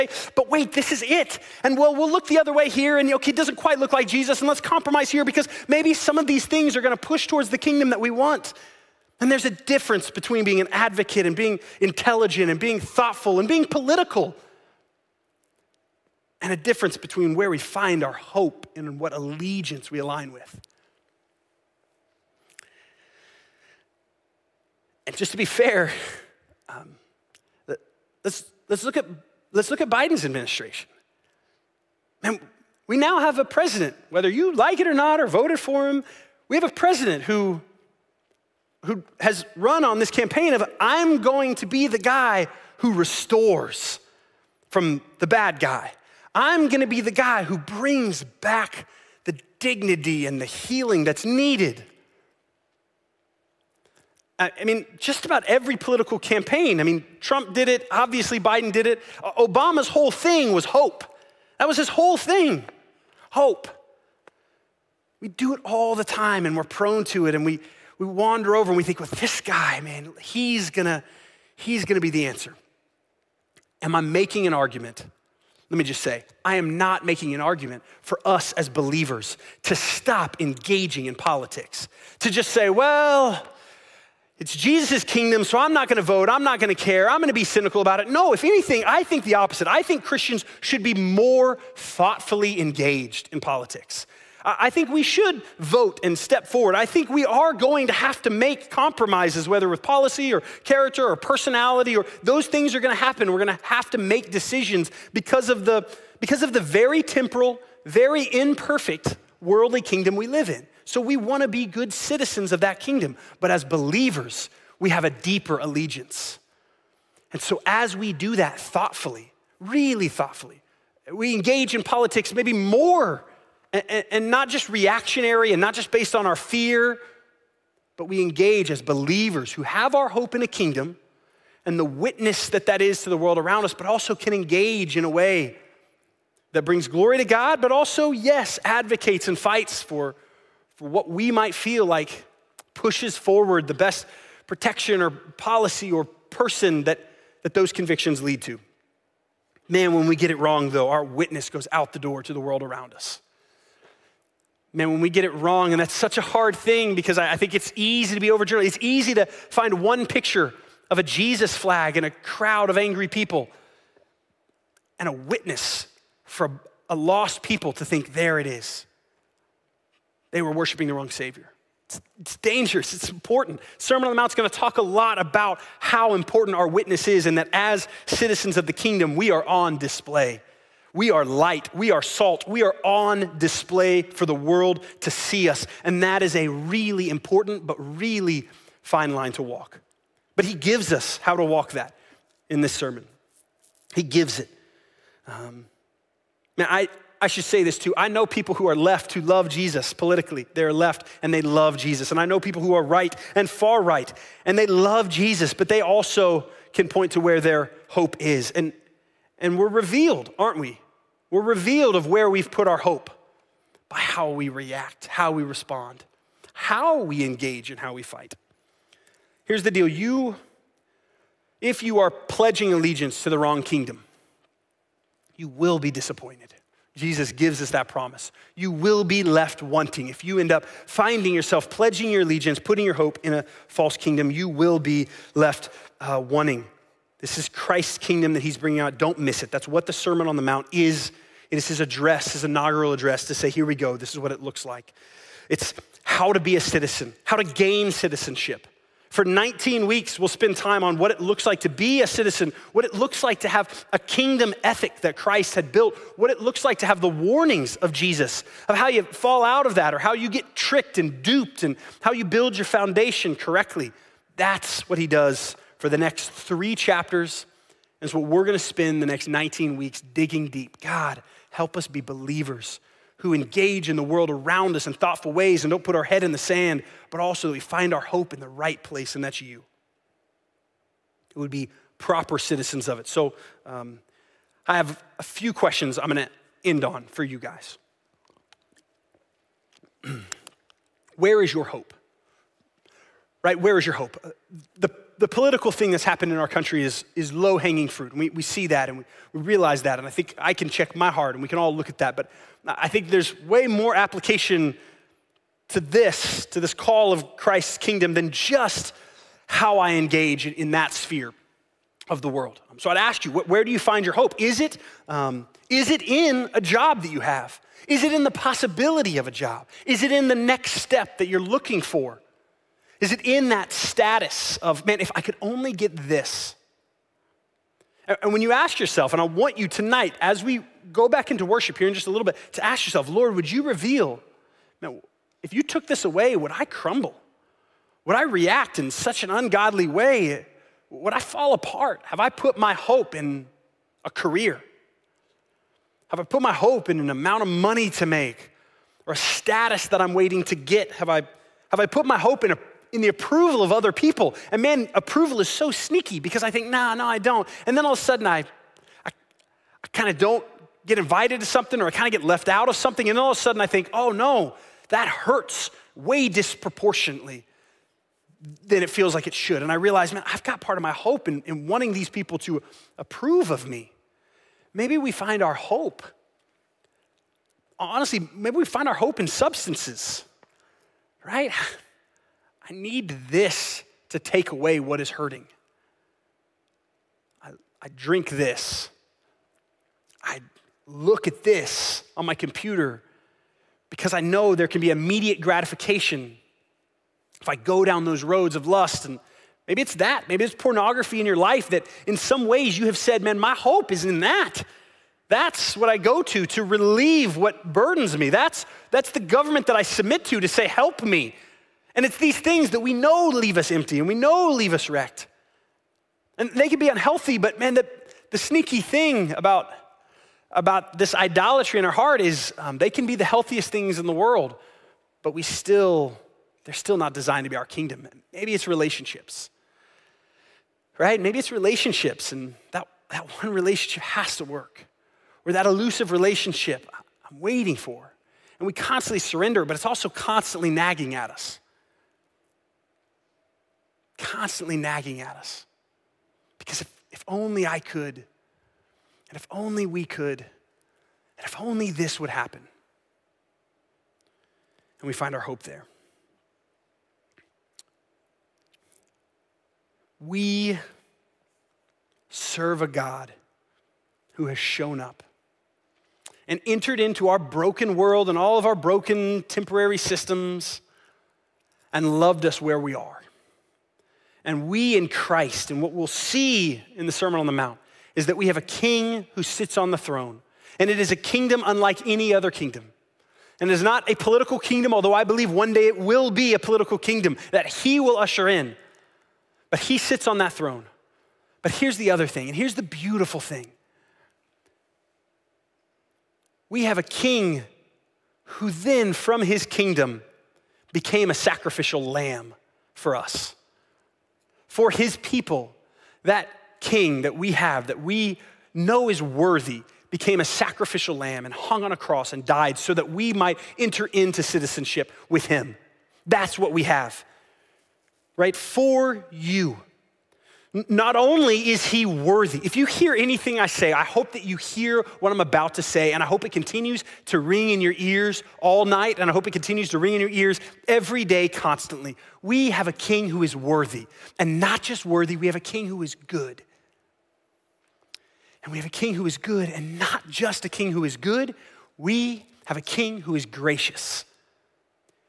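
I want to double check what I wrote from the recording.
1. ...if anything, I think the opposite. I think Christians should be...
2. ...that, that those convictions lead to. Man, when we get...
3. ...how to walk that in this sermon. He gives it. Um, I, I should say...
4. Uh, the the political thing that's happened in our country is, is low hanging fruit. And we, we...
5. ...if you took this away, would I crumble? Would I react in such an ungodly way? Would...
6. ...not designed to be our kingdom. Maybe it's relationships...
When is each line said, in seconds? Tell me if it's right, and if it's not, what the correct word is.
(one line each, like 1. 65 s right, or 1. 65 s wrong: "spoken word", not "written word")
1. 88 s right
2. 146 s right
3. 191 s right
4. 294 s right
5. 335 s right
6. 426 s right.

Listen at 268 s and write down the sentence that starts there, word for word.
And it's what we're going to spend the next 19 weeks digging deep.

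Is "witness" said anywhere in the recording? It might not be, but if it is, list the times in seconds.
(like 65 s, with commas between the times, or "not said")
131 s, 151 s, 165 s, 176 s.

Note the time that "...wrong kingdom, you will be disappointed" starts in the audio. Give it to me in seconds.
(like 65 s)
223 s.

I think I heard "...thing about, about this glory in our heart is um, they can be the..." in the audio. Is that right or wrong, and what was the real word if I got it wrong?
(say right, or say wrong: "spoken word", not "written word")
wrong: "idolatry", not "glory".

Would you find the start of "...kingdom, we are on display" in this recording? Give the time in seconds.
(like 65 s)
178 s.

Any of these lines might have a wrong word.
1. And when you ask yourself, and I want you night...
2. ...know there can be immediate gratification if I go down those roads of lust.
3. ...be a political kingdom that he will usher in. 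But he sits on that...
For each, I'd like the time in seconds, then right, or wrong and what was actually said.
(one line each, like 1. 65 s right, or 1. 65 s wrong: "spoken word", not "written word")
1. 328 s wrong: "tonight", not "night"
2. 394 s right
3. 486 s right.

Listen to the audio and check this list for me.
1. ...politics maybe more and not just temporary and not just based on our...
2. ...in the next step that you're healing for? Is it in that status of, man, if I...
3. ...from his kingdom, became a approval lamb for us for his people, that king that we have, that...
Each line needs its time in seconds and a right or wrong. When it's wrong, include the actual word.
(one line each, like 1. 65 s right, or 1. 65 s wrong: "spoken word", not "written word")
1. 121 s wrong: "reactionary", not "temporary"
2. 320 s wrong: "looking", not "healing"
3. 499 s wrong: "sacrificial", not "approval".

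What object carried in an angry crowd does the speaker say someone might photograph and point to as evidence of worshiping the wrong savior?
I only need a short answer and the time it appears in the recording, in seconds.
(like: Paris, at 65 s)
a Jesus flag, at 161 s.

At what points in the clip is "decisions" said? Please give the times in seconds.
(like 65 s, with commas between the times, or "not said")
104 s.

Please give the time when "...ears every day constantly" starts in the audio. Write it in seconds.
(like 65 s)
530 s.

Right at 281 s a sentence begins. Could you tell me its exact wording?
It would be proper citizens of it.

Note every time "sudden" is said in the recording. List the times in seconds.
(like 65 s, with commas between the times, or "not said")
358 s, 363 s.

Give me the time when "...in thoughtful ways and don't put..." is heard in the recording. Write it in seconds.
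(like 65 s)
274 s.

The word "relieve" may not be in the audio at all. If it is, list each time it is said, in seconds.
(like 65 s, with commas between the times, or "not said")
406 s.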